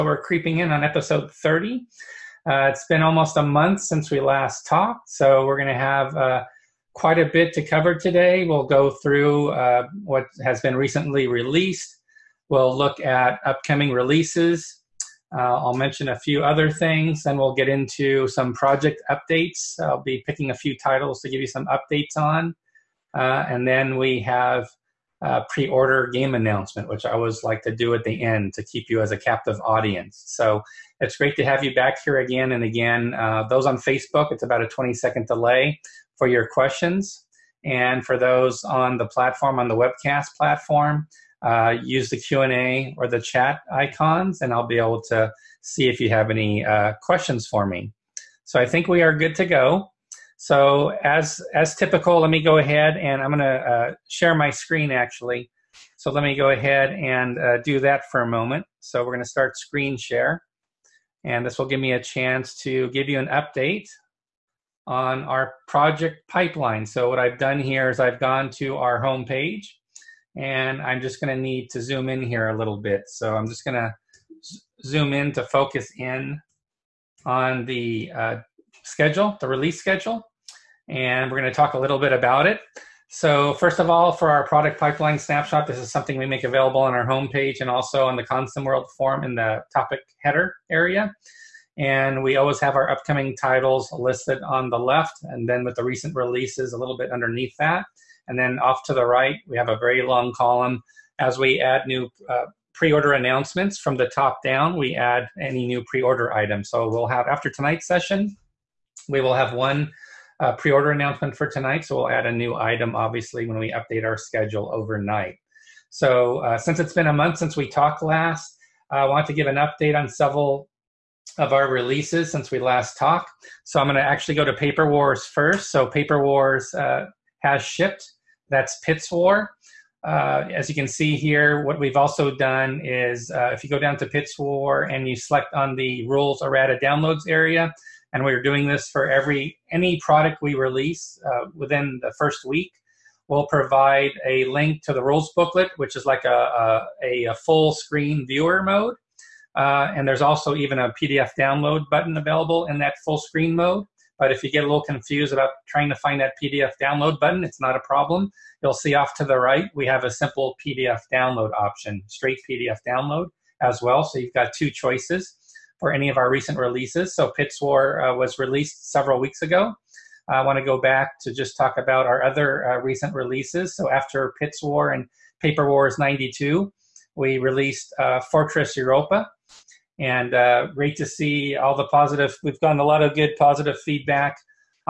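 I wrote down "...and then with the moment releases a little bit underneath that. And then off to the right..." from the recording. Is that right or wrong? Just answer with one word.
wrong.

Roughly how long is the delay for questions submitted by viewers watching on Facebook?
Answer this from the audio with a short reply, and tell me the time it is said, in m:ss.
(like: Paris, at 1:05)
20 seconds, at 0:34.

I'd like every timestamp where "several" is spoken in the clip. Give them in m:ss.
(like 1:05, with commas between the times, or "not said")
2:00, 2:48.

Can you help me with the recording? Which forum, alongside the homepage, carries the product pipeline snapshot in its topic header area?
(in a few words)
ConsimWorld.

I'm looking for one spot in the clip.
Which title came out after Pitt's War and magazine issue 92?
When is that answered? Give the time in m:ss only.
2:58.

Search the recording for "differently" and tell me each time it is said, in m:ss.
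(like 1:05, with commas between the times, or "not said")
not said.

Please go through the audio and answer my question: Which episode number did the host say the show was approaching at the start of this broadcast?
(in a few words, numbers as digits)
30.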